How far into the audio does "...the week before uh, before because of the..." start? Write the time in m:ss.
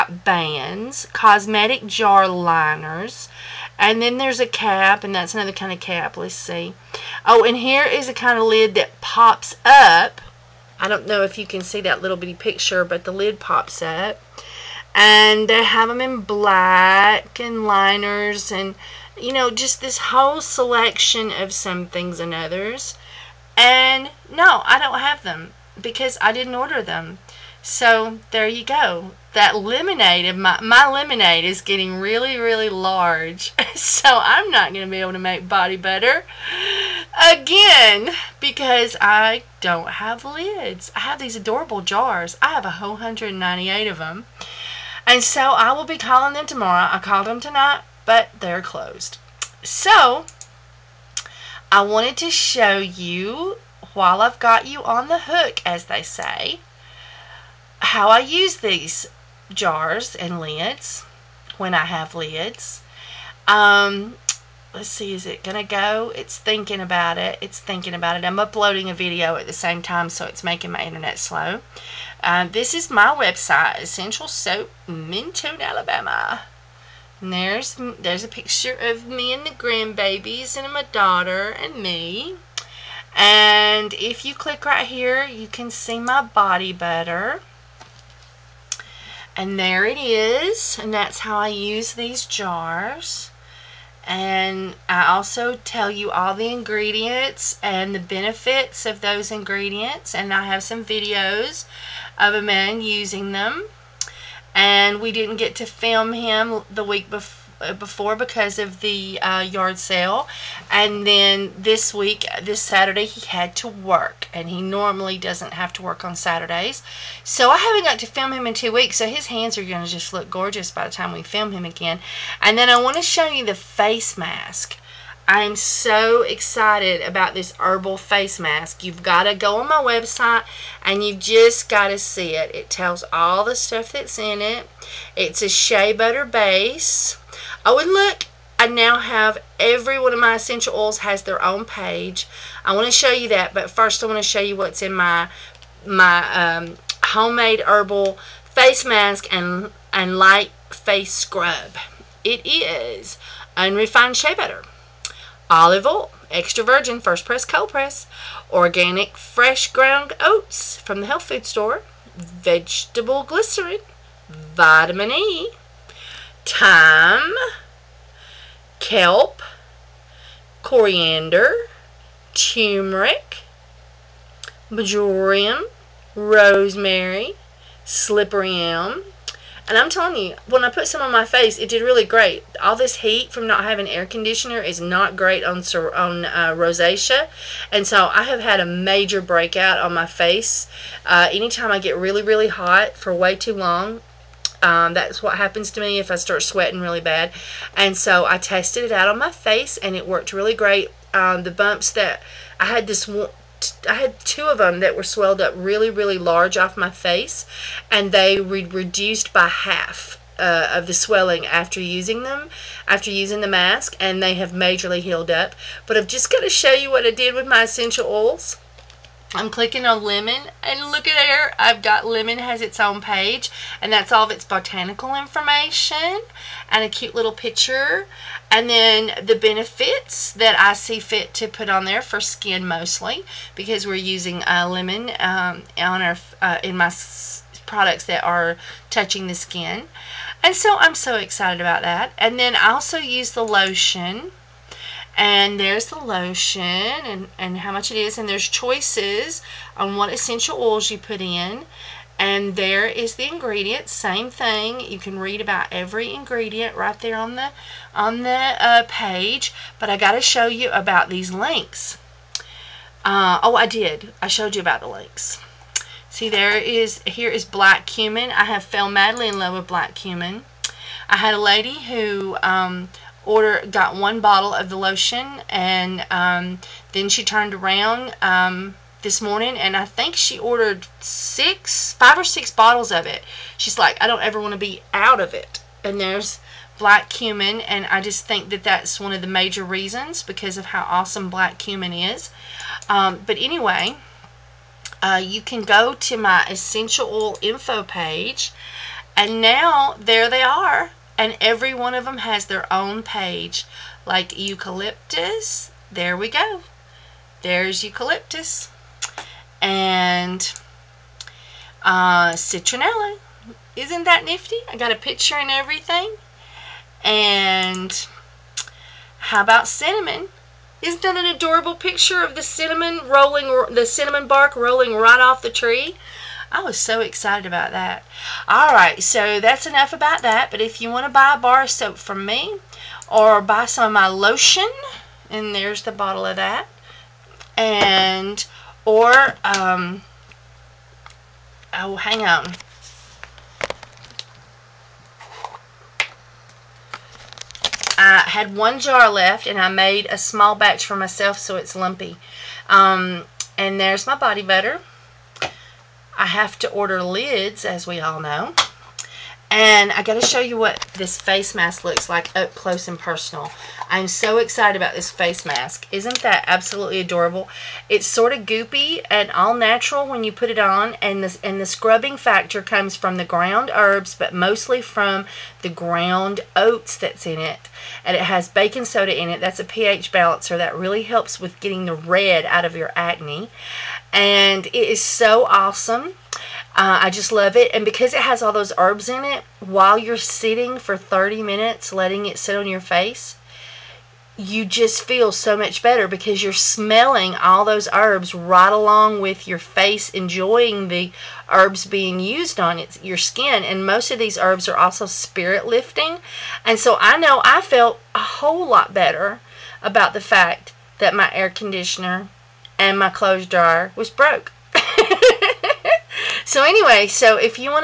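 1:46.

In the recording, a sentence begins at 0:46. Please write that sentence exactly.
I called them tonight, but they're closed.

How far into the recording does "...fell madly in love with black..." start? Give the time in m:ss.
4:28.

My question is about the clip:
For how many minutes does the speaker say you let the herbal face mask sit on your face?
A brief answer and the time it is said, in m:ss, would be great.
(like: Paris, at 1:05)
30, at 6:30.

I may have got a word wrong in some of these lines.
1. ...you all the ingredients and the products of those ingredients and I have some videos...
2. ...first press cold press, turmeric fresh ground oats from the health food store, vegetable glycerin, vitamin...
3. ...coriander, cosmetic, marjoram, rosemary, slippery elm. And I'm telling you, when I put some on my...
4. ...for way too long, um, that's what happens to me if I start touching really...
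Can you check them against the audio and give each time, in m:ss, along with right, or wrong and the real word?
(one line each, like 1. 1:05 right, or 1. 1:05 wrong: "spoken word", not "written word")
1. 1:35 wrong: "benefits", not "products"
2. 2:36 wrong: "organic", not "turmeric"
3. 2:50 wrong: "turmeric", not "cosmetic"
4. 3:12 wrong: "sweating", not "touching".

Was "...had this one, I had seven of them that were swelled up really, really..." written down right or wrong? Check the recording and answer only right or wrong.
wrong.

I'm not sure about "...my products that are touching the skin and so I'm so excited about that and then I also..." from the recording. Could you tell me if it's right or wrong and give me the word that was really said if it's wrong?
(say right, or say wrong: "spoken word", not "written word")
right.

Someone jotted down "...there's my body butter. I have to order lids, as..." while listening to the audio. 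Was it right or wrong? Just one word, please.
right.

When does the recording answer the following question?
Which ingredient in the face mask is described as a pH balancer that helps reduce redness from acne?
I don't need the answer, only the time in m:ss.
6:18.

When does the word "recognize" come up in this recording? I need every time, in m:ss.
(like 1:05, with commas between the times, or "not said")
not said.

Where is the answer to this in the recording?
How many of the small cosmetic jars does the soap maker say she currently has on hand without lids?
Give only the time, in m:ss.
0:42.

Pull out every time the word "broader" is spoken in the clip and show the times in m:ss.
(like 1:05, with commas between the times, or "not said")
not said.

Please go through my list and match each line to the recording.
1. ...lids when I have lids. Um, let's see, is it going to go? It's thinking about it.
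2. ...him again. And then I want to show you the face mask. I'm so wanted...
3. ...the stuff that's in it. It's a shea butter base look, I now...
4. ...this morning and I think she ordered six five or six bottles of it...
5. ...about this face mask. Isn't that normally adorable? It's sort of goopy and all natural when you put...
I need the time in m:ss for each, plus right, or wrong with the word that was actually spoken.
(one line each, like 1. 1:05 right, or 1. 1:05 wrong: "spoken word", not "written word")
1. 1:00 right
2. 2:01 wrong: "excited", not "wanted"
3. 2:13 right
4. 4:39 right
5. 6:04 wrong: "absolutely", not "normally".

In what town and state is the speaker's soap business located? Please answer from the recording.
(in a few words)
Mentone, Alabama.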